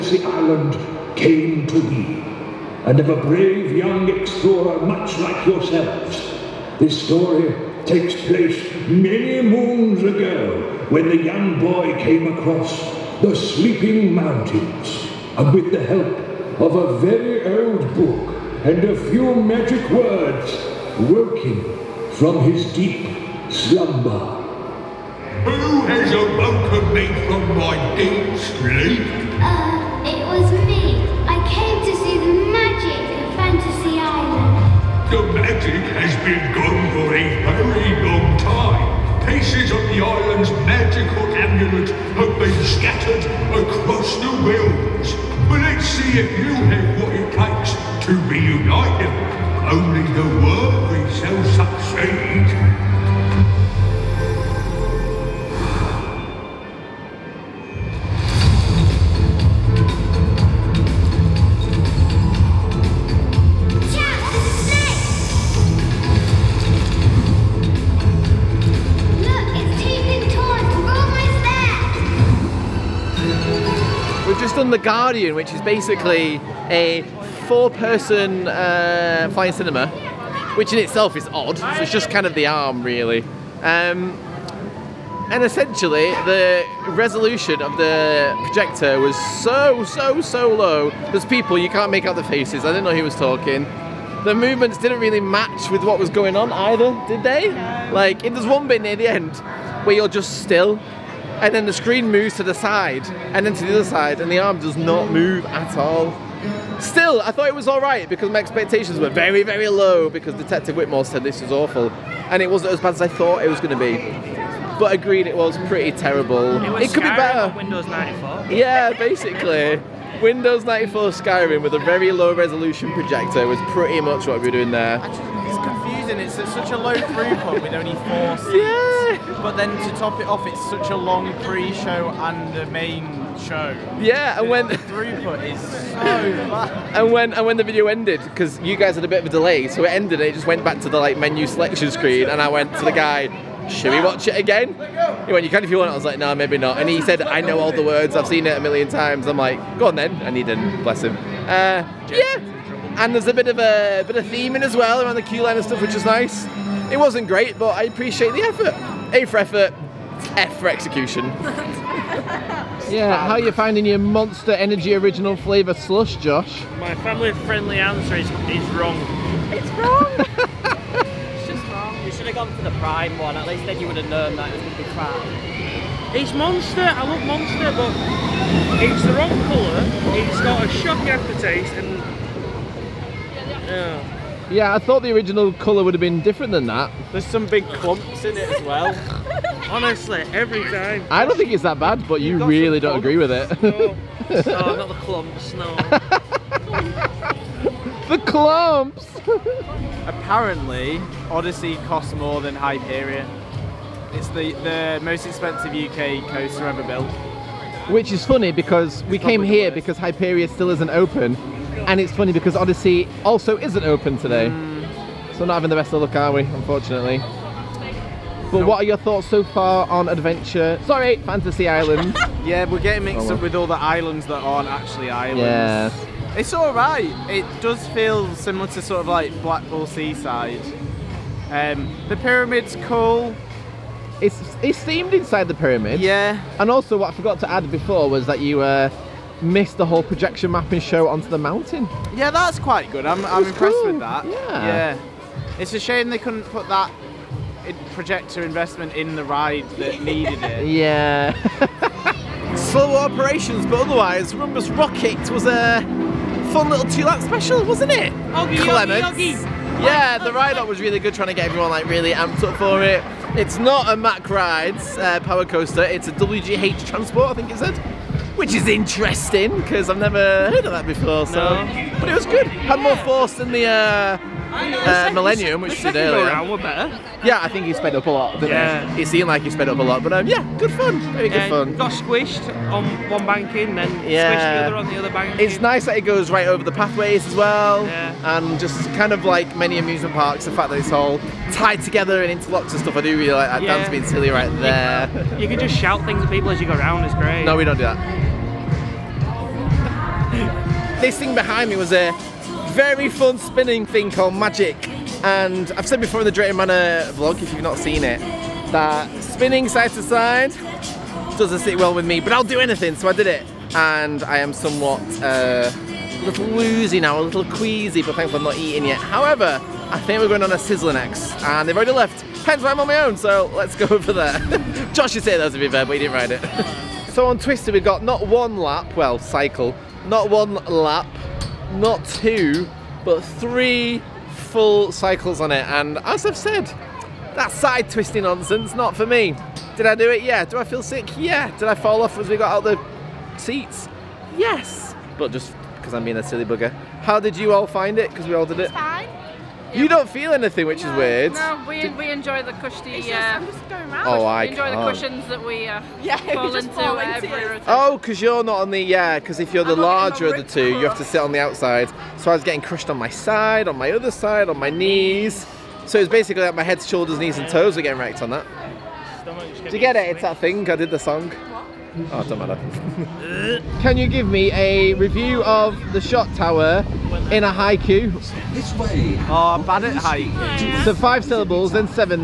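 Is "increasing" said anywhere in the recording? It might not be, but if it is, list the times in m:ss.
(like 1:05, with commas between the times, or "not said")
not said.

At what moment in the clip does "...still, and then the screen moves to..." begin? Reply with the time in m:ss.
1:40.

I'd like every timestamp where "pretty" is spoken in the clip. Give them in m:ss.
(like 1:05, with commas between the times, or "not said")
1:55, 2:03.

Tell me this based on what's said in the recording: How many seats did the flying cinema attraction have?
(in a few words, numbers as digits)
4.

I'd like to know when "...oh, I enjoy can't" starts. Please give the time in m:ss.
5:54.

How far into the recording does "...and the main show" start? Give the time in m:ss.
2:12.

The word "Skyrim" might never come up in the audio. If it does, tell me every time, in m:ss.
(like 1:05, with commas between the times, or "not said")
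1:57, 2:01.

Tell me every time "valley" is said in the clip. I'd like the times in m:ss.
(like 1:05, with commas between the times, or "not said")
not said.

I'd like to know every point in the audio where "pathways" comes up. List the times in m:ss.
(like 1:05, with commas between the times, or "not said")
4:46.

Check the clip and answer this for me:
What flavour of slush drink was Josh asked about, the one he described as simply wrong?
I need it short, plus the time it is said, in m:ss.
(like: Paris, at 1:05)
Monster Energy Original Flavour, at 2:43.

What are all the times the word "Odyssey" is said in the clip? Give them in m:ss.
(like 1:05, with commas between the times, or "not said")
3:21, 3:32.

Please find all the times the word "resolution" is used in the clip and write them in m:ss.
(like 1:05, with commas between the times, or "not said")
1:26, 2:02.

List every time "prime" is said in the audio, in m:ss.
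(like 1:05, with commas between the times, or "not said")
2:52.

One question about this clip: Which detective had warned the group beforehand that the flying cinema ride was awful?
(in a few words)
Detective Whitmore.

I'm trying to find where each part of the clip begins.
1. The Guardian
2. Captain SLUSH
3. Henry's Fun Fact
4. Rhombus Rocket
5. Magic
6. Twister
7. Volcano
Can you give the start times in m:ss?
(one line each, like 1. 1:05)
1. 1:12
2. 2:42
3. 3:19
4. 4:12
5. 5:00
6. 5:26
7. 6:13.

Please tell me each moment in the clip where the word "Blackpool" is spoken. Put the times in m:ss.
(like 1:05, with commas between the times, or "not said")
3:49.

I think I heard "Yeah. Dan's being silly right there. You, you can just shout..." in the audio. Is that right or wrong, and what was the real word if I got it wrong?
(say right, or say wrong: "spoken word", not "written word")
right.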